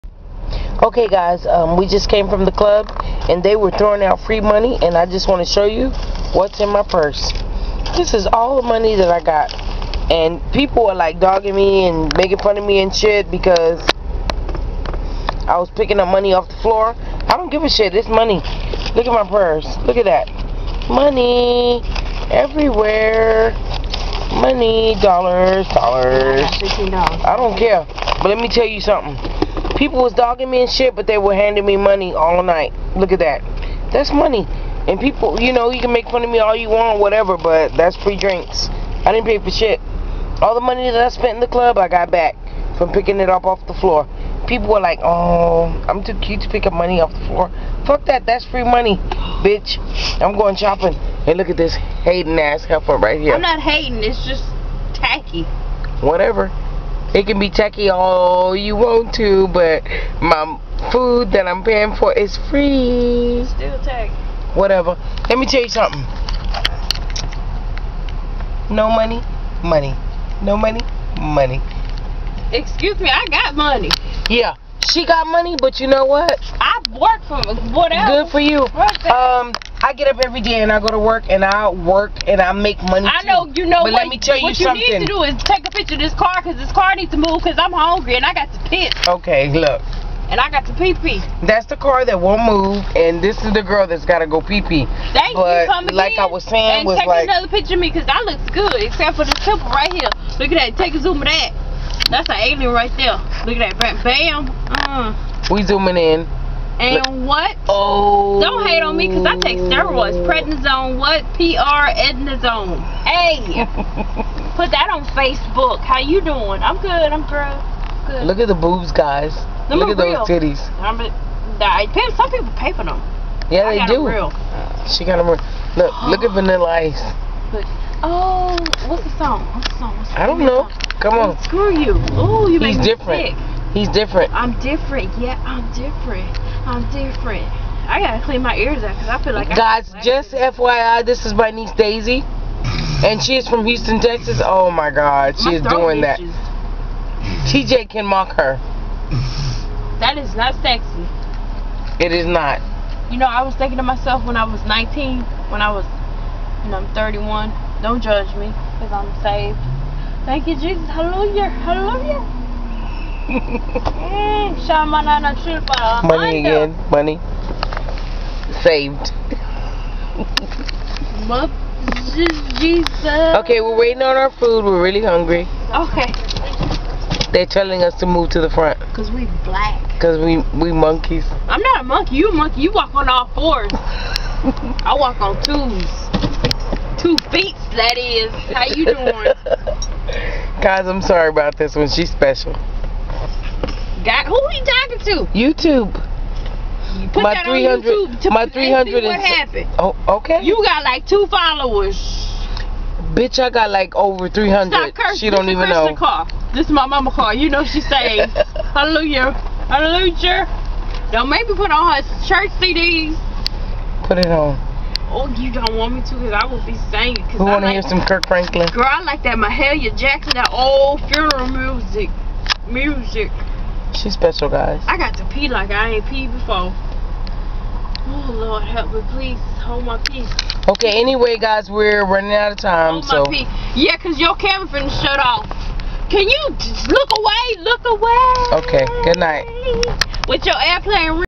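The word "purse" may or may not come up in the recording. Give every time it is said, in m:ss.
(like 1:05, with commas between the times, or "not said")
0:06, 0:19.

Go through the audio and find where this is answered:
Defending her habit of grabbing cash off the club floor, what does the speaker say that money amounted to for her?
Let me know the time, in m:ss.
0:37.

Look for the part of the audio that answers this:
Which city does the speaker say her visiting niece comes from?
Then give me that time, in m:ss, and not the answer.
2:23.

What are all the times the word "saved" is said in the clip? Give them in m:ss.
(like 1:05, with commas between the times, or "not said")
2:39, 2:48, 3:27.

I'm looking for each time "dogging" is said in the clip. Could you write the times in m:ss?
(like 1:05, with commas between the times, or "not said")
0:11, 0:30.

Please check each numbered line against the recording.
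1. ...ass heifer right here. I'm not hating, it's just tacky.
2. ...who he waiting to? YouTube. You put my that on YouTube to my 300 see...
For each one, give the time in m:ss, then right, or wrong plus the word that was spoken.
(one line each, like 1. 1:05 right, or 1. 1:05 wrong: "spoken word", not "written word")
1. 0:52 right
2. 3:14 wrong: "talking", not "waiting".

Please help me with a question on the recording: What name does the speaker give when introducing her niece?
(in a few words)
Daisy.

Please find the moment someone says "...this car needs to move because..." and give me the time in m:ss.
1:26.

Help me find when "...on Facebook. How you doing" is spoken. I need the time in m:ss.
1:54.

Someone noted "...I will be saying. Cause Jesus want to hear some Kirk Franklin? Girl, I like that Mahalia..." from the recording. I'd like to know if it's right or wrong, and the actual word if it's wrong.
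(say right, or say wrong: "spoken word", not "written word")
wrong: "Who", not "Jesus".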